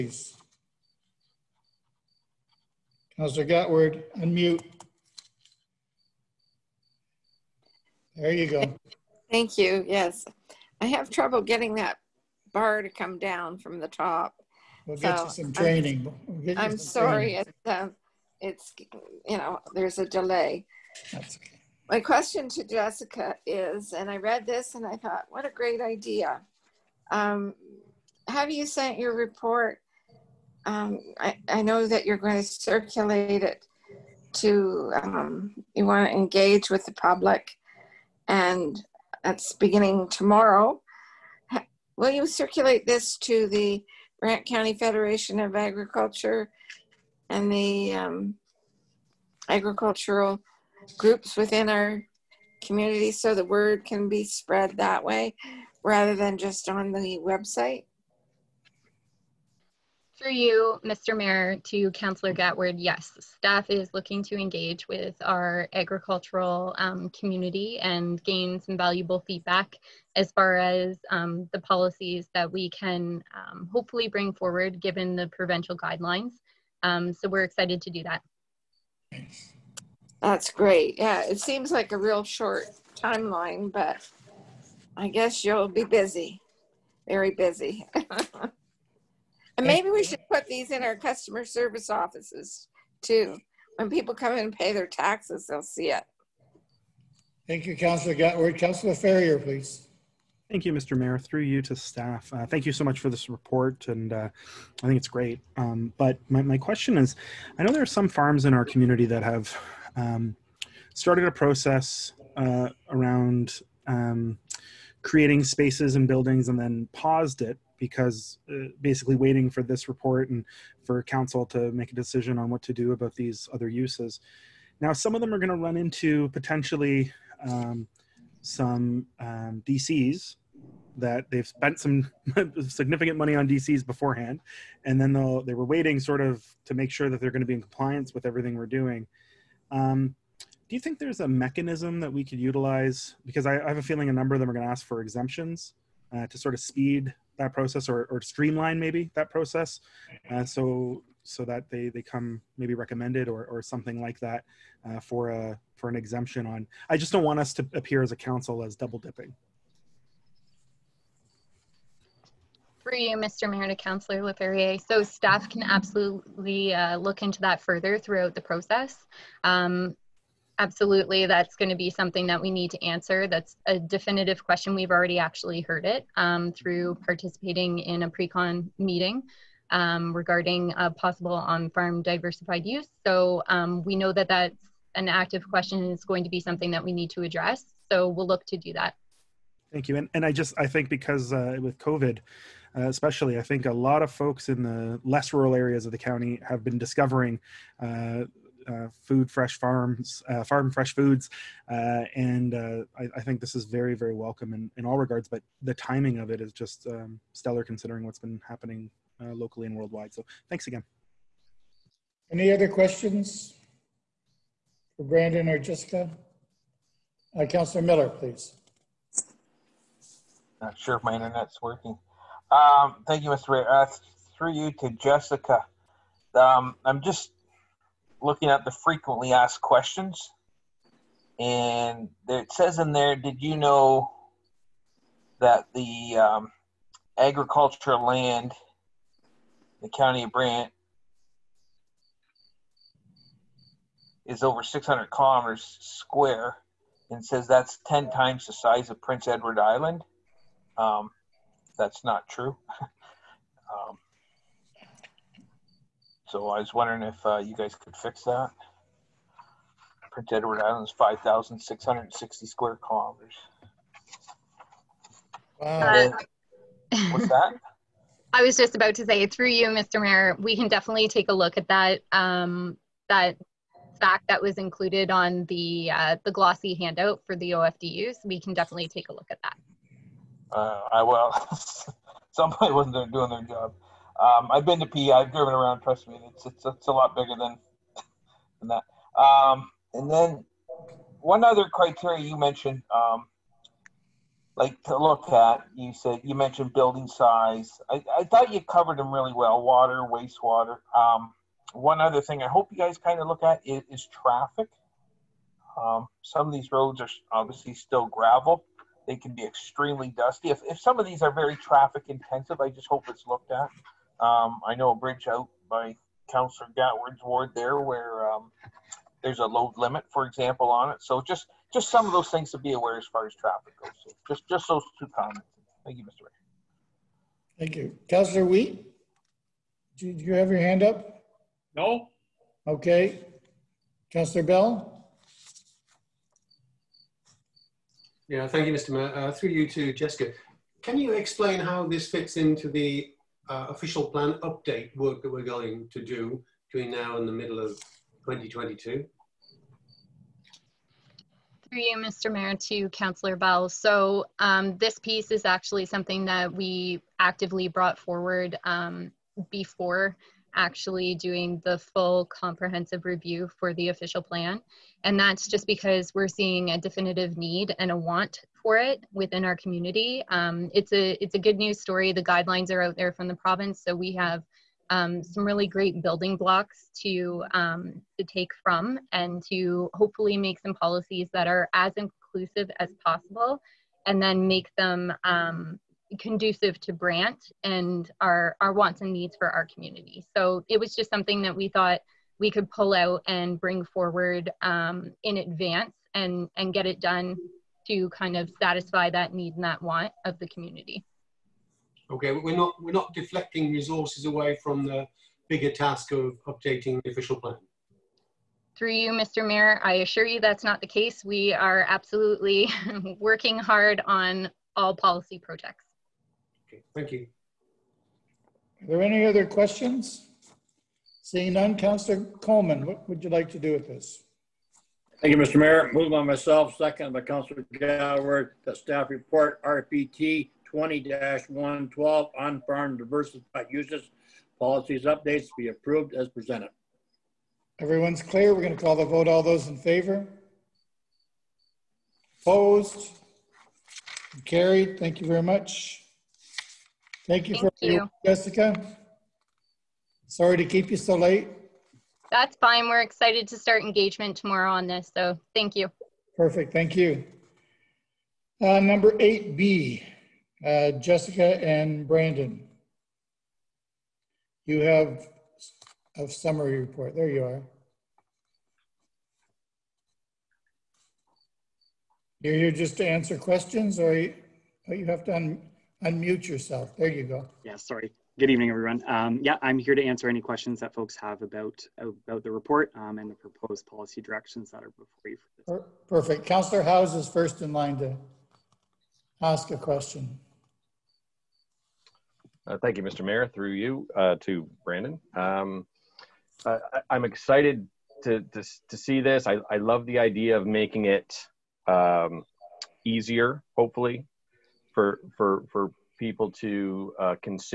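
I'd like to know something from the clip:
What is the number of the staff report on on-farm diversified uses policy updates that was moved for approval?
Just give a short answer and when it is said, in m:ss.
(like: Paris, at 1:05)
RPT 20-112, at 7:09.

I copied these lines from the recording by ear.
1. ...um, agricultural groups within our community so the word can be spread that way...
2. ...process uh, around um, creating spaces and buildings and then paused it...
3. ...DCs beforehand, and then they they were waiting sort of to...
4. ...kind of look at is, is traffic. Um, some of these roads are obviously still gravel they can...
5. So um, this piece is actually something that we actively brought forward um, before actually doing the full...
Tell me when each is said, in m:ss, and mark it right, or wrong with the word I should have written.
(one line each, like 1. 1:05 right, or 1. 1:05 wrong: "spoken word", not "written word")
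1. 0:47 right
2. 1:51 right
3. 2:13 right
4. 5:02 right
5. 5:53 right.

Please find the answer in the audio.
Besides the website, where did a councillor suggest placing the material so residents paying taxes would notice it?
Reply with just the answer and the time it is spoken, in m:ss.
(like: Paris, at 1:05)
customer service offices, at 1:30.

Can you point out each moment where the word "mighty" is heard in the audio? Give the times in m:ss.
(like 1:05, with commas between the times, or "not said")
not said.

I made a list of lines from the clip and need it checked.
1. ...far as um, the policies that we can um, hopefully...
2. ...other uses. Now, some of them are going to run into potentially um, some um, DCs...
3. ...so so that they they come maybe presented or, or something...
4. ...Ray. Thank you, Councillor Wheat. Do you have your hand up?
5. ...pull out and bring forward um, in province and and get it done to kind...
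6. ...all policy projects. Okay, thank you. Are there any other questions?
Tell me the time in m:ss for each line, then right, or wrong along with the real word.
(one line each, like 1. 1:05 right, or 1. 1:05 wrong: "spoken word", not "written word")
1. 1:10 right
2. 2:03 right
3. 2:30 wrong: "recommended", not "presented"
4. 5:26 right
5. 6:32 wrong: "advance", not "province"
6. 6:54 right.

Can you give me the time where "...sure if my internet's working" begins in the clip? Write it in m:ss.
3:40.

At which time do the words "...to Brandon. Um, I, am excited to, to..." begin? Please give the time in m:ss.
8:14.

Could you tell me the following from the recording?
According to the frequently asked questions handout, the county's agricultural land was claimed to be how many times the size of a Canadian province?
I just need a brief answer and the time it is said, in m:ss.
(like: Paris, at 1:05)
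10, at 4:07.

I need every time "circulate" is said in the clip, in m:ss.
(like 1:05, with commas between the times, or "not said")
0:32, 0:42.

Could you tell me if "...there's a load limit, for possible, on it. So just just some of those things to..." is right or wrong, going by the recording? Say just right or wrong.
wrong.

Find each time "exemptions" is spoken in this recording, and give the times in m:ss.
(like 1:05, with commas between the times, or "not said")
2:24, 2:35.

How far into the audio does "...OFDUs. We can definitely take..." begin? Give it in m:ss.
4:37.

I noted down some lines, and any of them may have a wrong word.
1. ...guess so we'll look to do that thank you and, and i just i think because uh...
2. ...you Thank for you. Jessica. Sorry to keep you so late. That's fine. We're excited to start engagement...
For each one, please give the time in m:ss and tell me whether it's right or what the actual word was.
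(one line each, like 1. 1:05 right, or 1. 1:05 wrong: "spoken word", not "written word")
1. 3:07 wrong: "address", not "guess"
2. 7:27 right.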